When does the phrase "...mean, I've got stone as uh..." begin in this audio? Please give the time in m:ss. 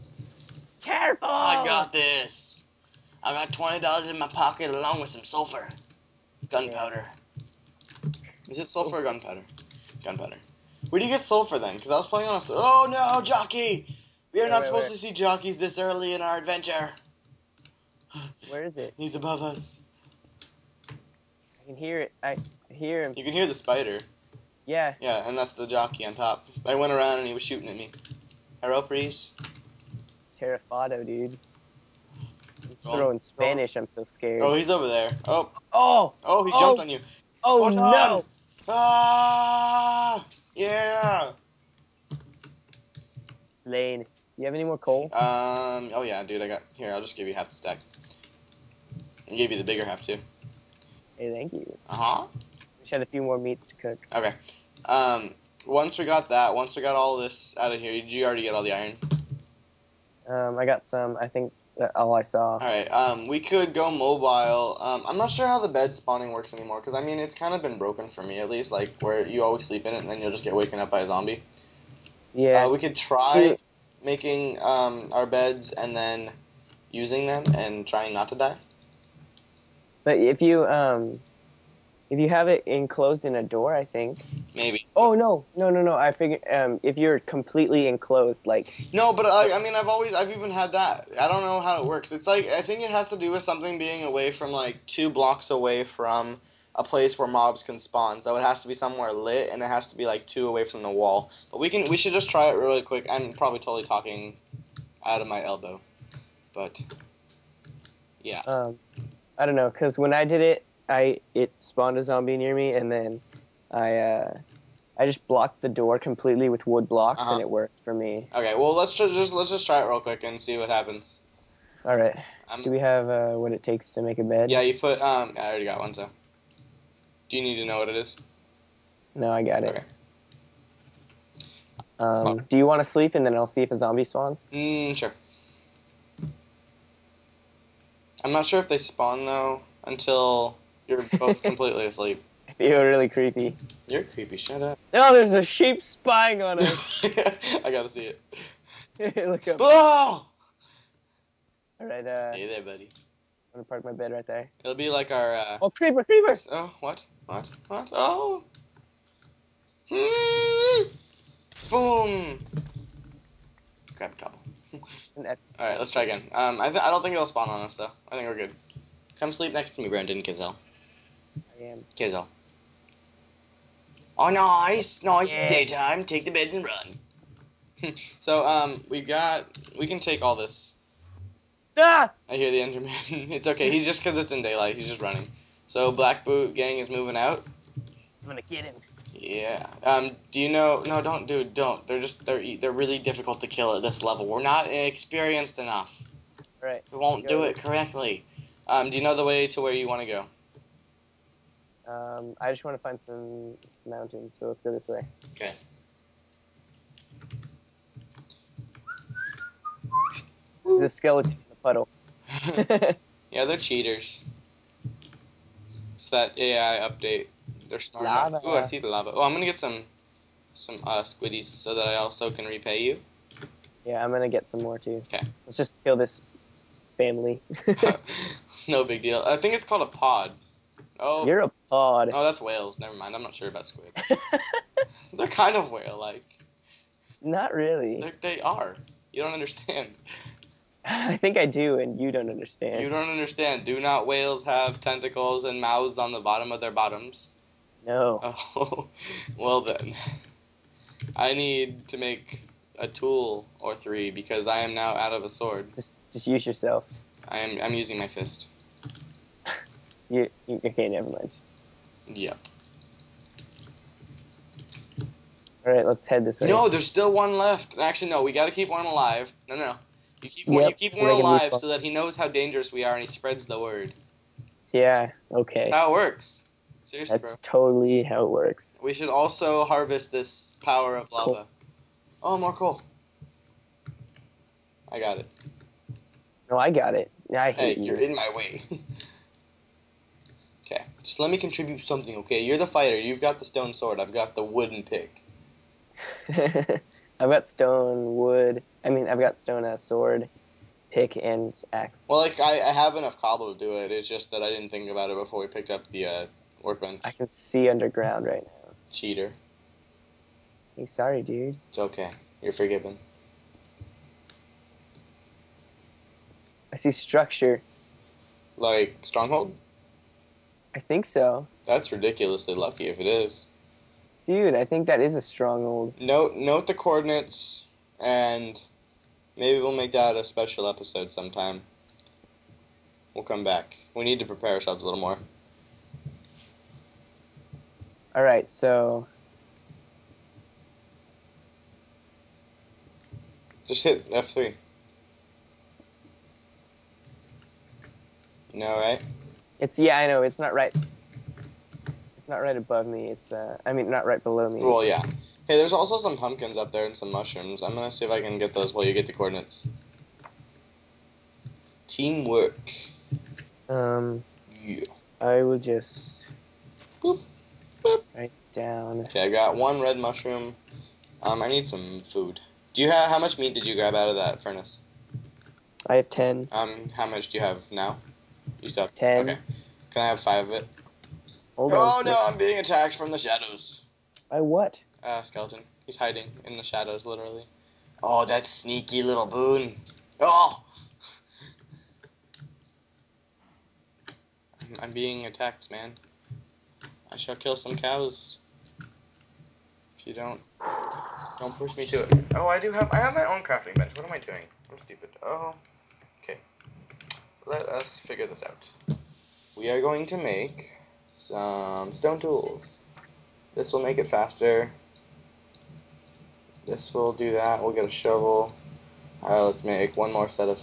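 4:58.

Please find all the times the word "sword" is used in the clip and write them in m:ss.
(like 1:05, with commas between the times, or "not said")
4:15, 4:53, 4:59.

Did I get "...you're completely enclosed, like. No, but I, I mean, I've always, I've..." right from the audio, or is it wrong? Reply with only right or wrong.
right.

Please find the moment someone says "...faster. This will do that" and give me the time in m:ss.
6:54.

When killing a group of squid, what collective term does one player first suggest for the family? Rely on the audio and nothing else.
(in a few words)
pod.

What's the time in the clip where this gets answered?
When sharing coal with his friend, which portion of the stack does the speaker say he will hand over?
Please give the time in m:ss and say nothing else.
0:49.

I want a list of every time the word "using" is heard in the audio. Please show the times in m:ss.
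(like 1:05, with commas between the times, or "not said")
1:16, 4:17.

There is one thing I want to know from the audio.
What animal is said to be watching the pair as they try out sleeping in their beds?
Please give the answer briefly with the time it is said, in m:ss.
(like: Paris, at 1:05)
a sheep, at 2:25.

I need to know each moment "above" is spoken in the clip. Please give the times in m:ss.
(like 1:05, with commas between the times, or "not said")
0:19, 5:52.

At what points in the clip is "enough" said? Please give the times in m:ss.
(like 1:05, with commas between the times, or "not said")
3:15, 5:02.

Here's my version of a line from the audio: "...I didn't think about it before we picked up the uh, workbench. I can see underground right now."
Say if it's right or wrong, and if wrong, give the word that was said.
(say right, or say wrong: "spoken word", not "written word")
right.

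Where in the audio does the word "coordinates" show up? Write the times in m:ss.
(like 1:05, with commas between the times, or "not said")
5:26, 5:59.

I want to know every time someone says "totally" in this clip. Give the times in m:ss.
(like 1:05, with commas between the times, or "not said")
1:43, 4:37.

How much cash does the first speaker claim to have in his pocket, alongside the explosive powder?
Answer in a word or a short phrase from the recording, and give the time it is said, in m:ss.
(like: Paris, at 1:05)
$20, at 0:03.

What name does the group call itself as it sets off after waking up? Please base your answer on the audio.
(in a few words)
Black Boot Gang.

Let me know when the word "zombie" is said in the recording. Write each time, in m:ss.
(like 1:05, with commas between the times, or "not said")
1:11, 1:52, 2:13.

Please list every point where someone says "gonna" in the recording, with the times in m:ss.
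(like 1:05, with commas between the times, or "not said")
2:33, 3:08, 3:39, 3:44, 5:57.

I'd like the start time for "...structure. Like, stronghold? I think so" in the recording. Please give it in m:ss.
5:16.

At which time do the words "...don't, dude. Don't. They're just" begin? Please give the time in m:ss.
3:11.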